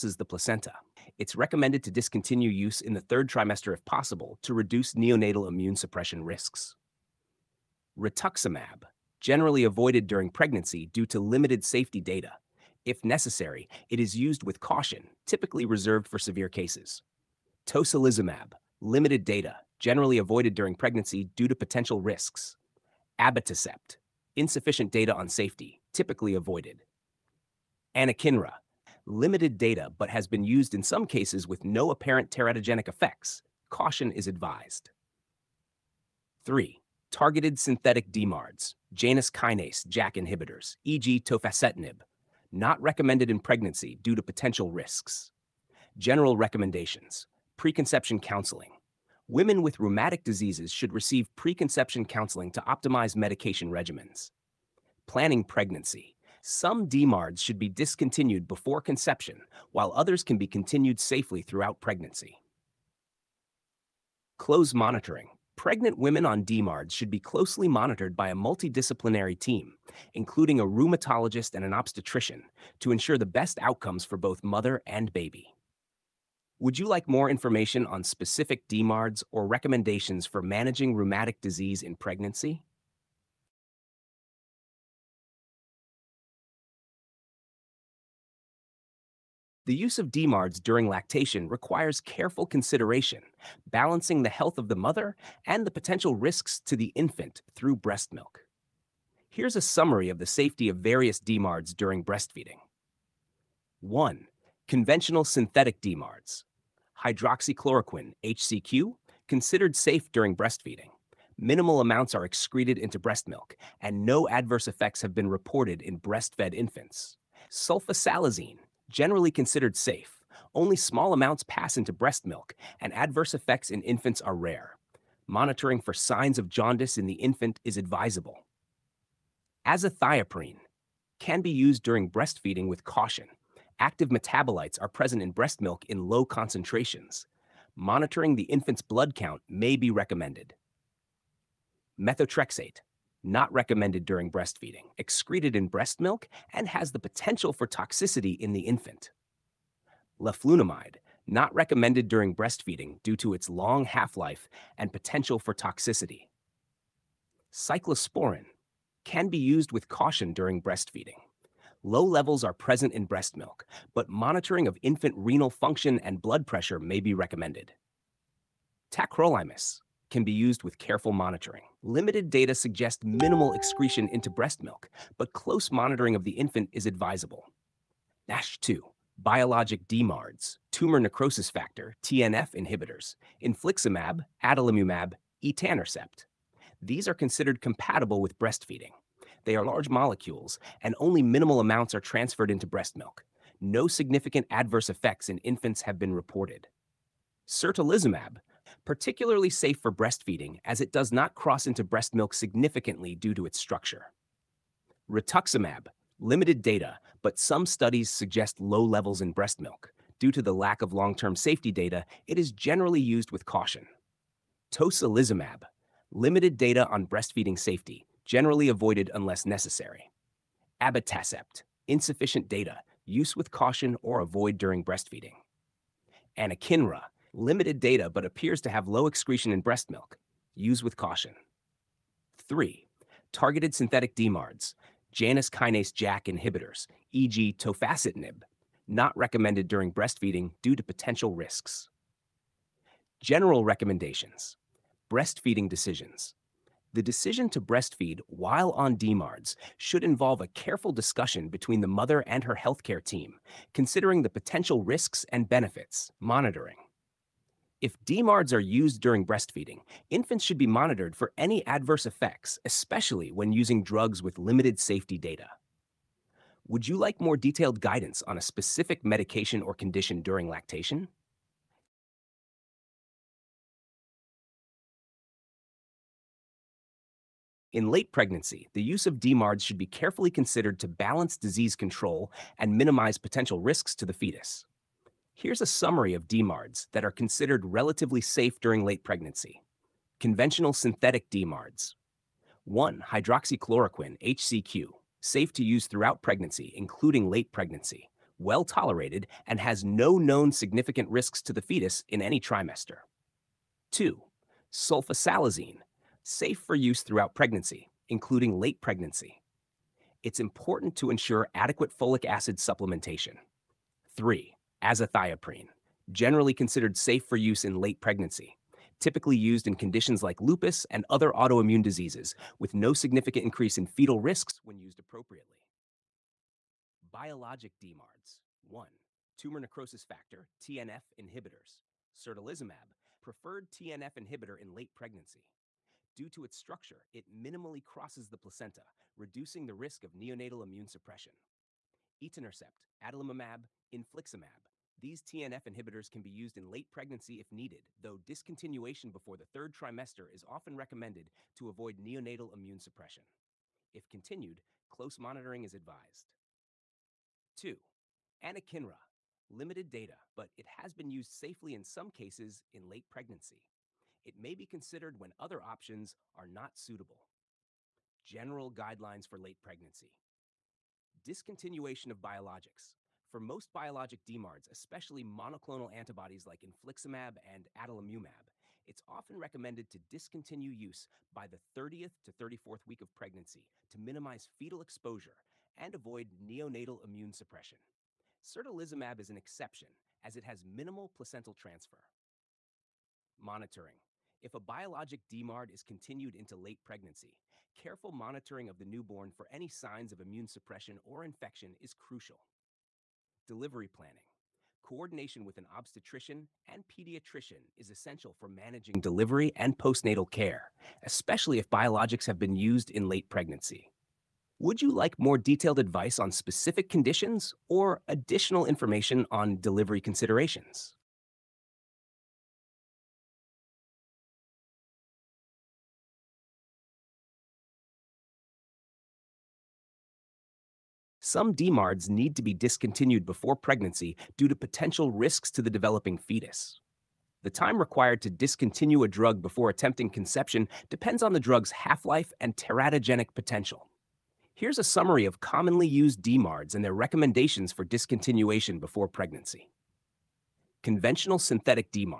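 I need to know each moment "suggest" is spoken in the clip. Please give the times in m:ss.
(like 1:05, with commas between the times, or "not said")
2:52, 3:28.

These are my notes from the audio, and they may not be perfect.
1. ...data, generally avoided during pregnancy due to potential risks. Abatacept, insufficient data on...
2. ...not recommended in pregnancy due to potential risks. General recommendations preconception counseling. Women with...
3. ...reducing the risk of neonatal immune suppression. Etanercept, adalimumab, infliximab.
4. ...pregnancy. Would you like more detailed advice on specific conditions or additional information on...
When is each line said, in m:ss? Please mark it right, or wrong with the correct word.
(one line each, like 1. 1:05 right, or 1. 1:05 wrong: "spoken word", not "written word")
1. 0:19 right
2. 0:42 right
3. 5:39 right
4. 6:53 right.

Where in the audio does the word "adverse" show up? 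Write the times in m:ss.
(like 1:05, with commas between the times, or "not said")
1:54, 2:02, 3:14, 4:21.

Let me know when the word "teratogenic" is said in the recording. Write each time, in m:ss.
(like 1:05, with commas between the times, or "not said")
0:32, 7:22.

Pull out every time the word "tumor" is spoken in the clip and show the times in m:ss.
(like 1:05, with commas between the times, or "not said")
3:00, 5:29.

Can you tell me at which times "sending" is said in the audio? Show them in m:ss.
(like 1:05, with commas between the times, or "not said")
not said.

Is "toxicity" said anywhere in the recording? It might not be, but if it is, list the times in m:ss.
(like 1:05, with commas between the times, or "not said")
2:27, 2:35.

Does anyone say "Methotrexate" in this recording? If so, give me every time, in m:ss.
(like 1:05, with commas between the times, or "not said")
2:21.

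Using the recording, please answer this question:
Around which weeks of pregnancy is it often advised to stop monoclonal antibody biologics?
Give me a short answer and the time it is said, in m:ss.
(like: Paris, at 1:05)
30th to 34th week, at 6:21.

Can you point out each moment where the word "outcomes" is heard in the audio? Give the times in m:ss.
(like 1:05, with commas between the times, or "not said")
1:13.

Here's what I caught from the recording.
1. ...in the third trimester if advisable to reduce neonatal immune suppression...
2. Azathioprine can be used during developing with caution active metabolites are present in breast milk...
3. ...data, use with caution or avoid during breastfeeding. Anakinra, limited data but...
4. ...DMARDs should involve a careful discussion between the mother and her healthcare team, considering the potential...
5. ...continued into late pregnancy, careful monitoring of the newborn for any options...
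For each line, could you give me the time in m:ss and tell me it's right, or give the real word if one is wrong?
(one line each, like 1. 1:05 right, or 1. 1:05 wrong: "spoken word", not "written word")
1. 0:02 wrong: "possible", not "advisable"
2. 2:09 wrong: "breastfeeding", not "developing"
3. 3:42 right
4. 4:08 right
5. 6:35 wrong: "signs", not "options".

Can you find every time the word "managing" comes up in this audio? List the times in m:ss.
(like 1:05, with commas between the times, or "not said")
1:20, 6:48.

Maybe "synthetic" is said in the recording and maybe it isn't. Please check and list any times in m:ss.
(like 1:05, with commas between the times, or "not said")
0:37, 1:45, 3:53, 4:50, 7:31.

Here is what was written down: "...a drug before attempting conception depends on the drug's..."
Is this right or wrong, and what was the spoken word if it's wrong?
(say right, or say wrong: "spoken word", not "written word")
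right.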